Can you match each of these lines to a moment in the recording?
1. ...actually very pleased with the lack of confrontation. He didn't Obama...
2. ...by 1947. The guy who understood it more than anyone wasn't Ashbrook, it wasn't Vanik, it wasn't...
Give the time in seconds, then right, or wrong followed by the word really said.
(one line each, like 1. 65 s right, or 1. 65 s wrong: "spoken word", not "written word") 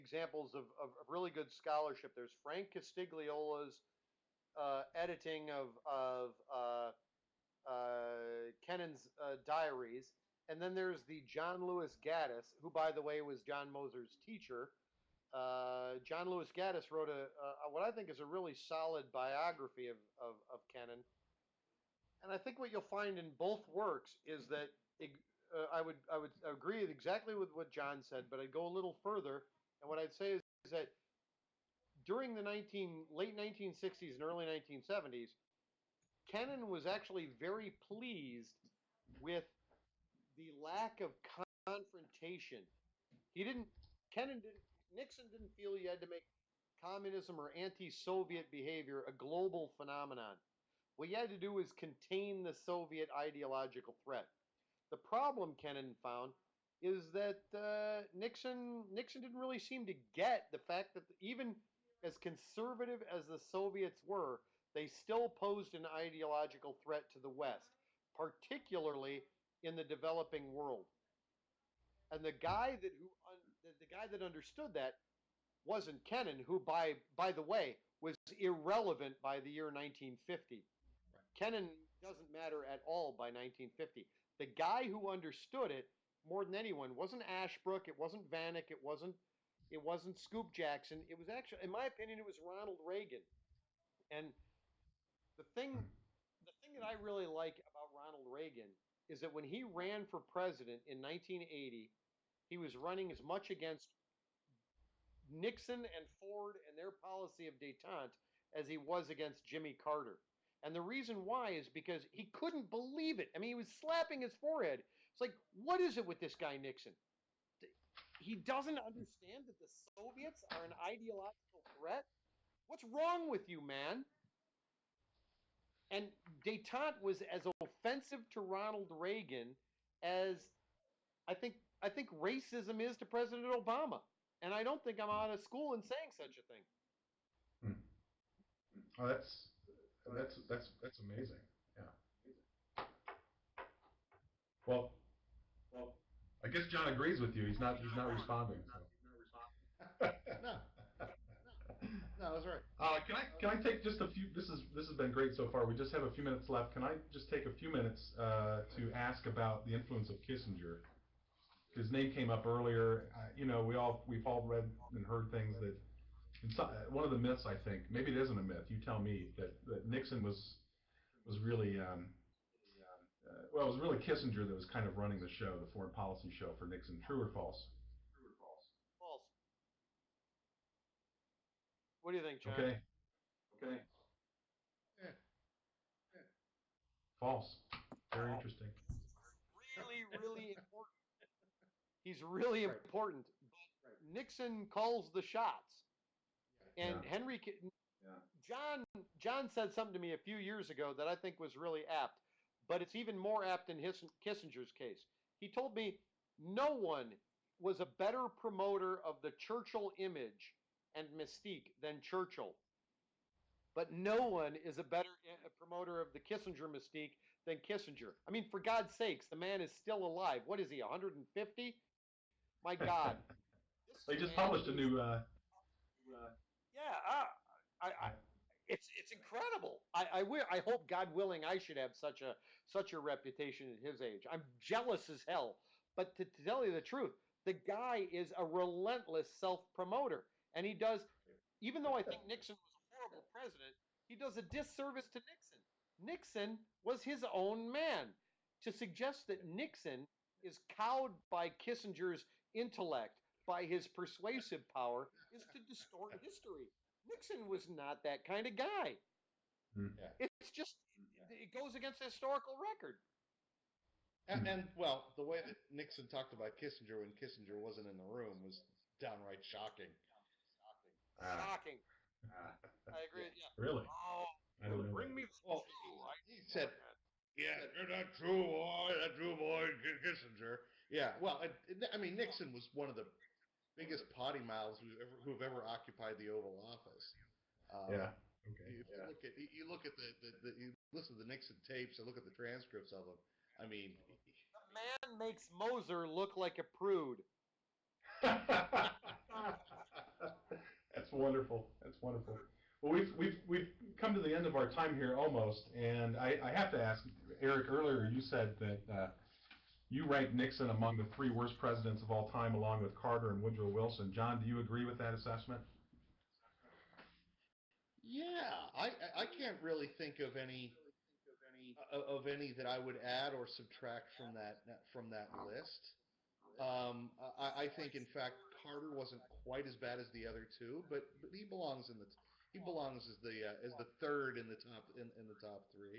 1. 36 s wrong: "Kennan", not "Obama"
2. 83 s wrong: "1950", not "1947".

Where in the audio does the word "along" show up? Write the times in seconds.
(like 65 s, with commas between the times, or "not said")
312 s.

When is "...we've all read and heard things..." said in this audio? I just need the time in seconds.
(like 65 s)
164 s.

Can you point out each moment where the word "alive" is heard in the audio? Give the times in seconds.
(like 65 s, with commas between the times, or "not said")
220 s.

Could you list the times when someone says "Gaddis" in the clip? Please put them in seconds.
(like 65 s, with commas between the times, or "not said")
12 s, 16 s.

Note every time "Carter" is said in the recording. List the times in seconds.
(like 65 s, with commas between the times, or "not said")
109 s, 312 s, 328 s.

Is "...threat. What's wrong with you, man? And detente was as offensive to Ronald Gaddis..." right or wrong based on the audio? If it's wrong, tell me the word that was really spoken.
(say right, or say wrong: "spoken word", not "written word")
wrong: "Reagan", not "Gaddis".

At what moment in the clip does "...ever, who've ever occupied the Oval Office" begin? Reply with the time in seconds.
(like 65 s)
285 s.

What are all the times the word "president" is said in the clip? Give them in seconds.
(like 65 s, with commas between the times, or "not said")
100 s, 133 s, 243 s, 311 s.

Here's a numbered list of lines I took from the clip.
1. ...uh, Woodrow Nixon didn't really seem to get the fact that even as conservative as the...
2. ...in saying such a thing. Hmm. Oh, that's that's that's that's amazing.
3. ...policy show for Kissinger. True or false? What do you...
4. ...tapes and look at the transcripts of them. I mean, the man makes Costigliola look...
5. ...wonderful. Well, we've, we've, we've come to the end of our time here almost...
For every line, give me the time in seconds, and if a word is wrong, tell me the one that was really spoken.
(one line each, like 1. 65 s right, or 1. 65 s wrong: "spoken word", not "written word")
1. 57 s wrong: "Nixon", not "Woodrow"
2. 135 s right
3. 175 s wrong: "Nixon", not "Kissinger"
4. 291 s wrong: "Moser", not "Costigliola"
5. 302 s right.